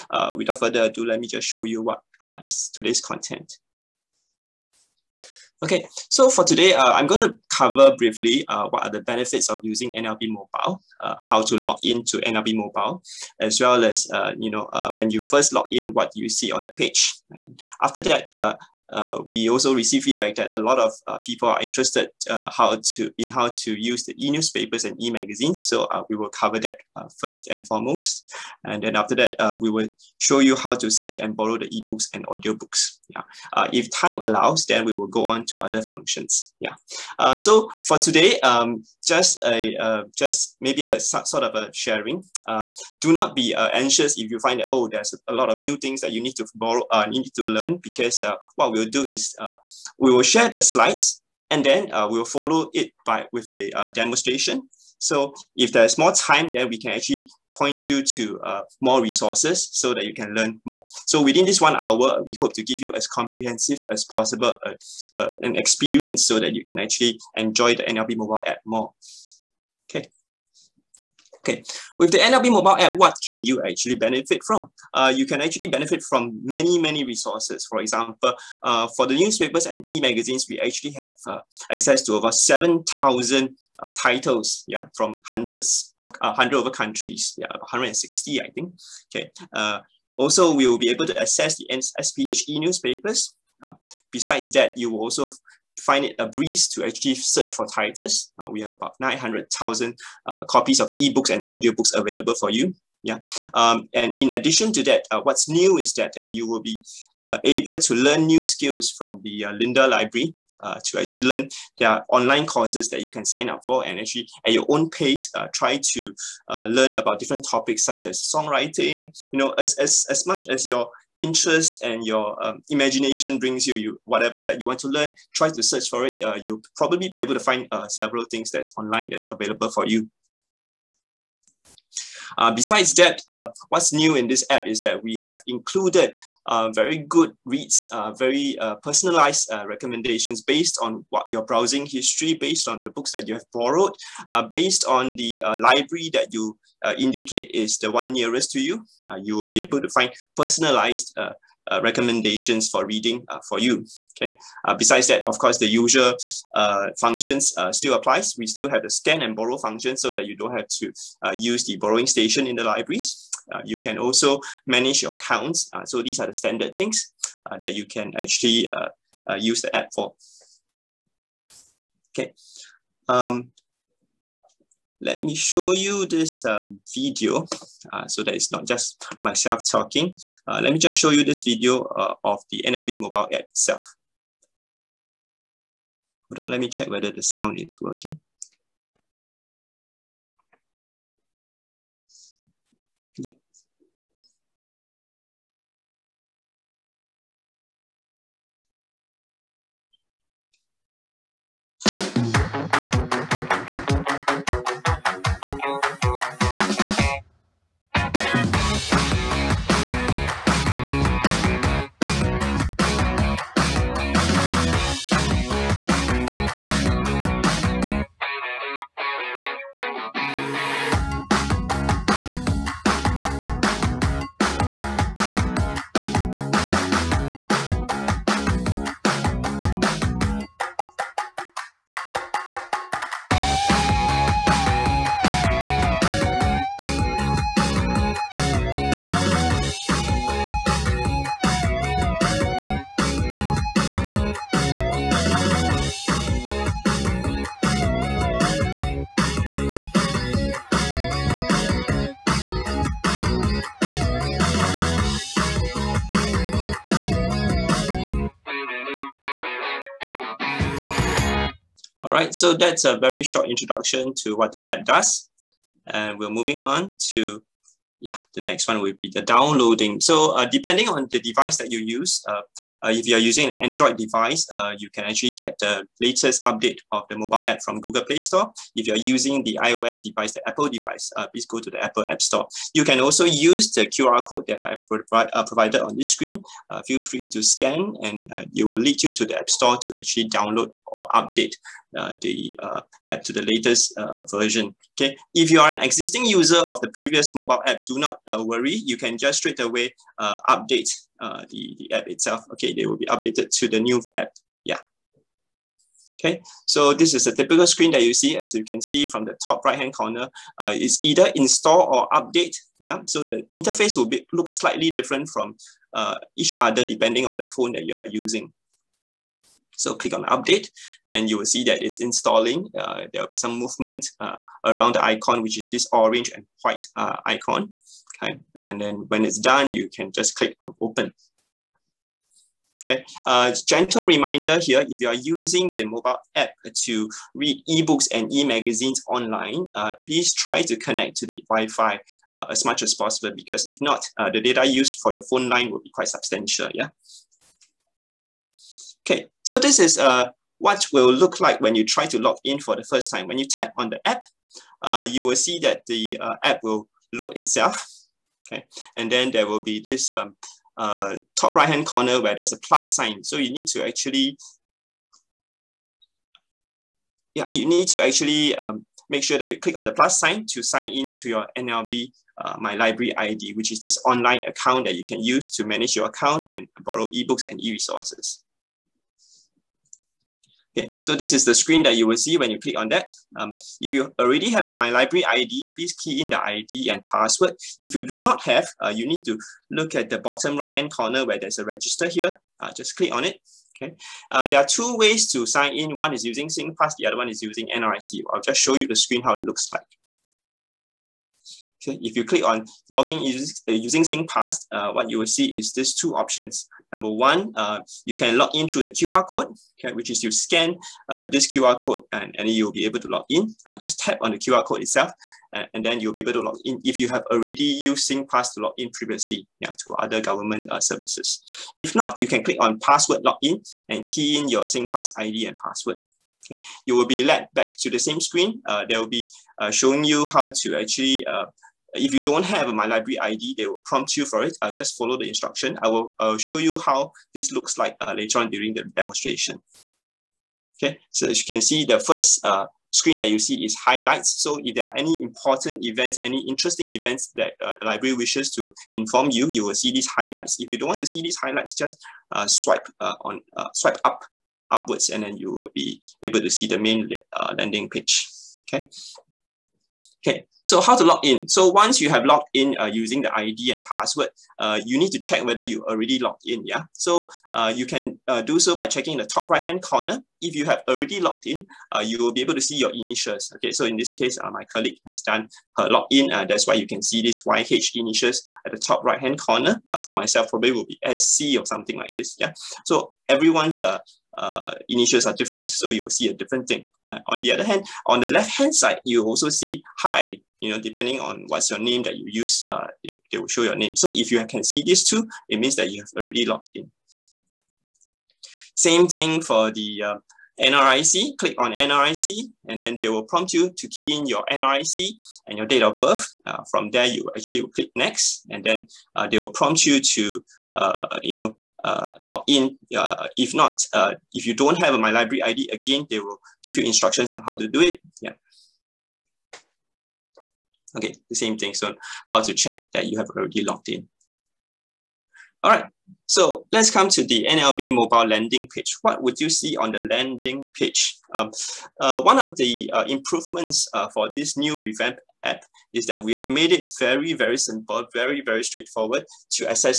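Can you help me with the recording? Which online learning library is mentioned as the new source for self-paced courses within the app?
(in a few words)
Lynda Library.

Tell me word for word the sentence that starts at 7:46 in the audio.
So uh, you can uh, do so by checking the top right-hand corner.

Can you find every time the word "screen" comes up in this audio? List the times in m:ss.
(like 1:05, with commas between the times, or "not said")
4:46, 5:07, 6:21, 6:38, 7:08, 7:22.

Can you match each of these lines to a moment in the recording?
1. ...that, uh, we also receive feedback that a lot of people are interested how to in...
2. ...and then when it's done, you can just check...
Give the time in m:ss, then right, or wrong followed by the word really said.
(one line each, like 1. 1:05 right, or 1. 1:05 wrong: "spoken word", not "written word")
1. 0:18 right
2. 5:28 wrong: "click", not "check".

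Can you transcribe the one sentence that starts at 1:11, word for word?
Okay, with the NLB mobile app, what can you actually benefit from?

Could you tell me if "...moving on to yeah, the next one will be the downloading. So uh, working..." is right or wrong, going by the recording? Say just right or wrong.
wrong.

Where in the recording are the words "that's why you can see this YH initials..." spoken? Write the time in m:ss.
7:56.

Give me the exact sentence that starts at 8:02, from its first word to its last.
So everyone's uh, initials are different, so you'll see a different thing.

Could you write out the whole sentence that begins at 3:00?
Uh, let me just show you this video uh, of the NLB mobile app itself.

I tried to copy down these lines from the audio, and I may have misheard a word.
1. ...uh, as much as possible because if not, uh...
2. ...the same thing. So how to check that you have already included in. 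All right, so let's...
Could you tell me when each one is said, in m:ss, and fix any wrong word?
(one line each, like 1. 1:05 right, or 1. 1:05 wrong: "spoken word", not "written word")
1. 5:42 right
2. 8:41 wrong: "logged", not "included".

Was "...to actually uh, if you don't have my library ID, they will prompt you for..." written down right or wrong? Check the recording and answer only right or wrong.
right.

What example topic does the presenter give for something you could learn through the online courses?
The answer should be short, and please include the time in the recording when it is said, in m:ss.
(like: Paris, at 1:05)
songwriting, at 1:58.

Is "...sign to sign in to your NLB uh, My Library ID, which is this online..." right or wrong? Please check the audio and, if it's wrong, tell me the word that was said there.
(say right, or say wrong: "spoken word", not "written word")
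right.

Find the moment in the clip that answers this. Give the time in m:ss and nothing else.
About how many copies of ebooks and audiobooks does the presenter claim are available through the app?
1:38.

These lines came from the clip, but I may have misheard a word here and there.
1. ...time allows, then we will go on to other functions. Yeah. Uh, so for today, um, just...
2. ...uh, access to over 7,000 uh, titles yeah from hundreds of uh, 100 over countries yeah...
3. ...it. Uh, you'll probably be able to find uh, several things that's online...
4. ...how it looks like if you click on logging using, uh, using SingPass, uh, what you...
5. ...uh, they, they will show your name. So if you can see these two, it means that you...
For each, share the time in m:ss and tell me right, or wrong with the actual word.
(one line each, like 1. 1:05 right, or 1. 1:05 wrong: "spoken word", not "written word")
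1. 0:33 right
2. 1:21 right
3. 2:06 right
4. 6:39 right
5. 8:12 right.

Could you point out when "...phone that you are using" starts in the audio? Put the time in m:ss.
5:17.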